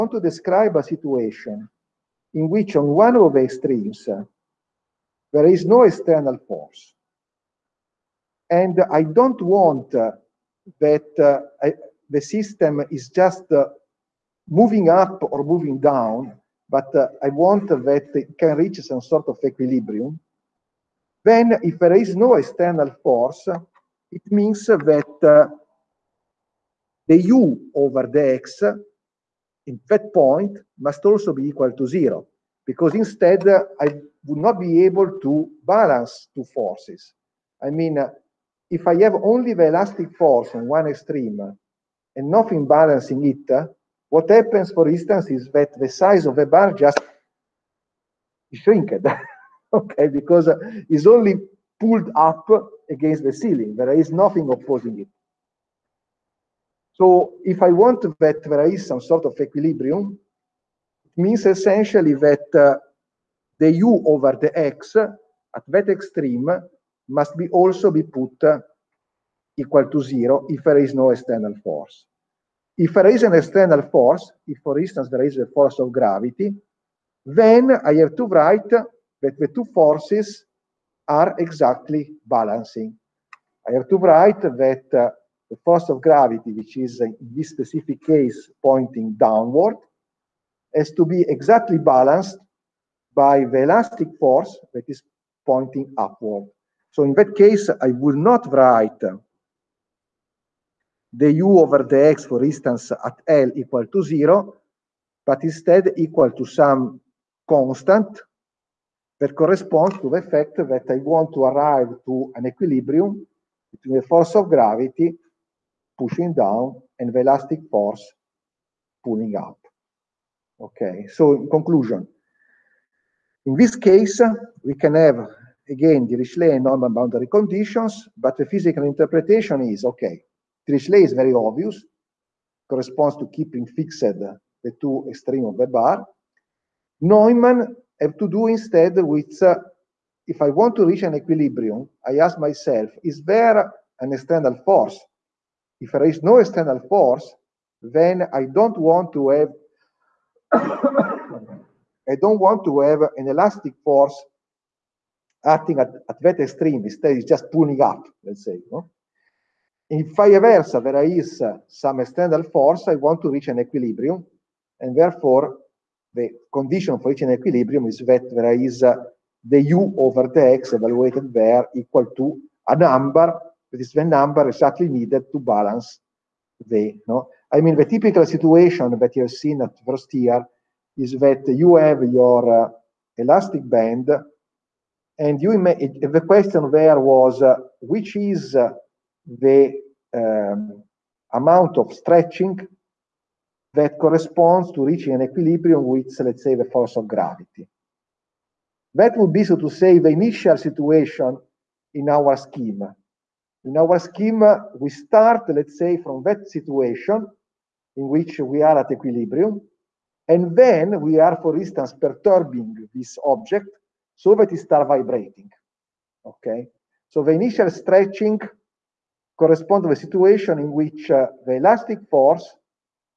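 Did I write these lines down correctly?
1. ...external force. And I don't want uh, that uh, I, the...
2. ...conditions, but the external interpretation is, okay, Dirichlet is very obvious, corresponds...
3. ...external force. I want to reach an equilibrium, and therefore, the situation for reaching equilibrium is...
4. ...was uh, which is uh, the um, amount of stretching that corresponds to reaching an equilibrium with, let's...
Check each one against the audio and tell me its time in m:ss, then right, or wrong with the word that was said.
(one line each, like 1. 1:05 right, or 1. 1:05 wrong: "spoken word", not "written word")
1. 0:05 right
2. 2:07 wrong: "physical", not "external"
3. 2:41 wrong: "condition", not "situation"
4. 3:06 right.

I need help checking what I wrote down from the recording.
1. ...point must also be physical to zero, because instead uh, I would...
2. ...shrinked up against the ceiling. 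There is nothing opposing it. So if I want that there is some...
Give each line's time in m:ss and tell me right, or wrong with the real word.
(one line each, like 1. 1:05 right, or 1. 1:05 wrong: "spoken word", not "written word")
1. 0:30 wrong: "equal", not "physical"
2. 0:51 wrong: "pulled", not "shrinked".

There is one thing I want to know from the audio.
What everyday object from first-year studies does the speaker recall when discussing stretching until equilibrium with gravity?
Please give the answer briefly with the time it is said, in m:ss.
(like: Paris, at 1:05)
elastic band, at 3:03.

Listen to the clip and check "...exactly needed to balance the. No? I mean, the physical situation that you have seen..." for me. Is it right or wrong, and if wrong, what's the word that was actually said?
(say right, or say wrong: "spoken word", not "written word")
wrong: "typical", not "physical".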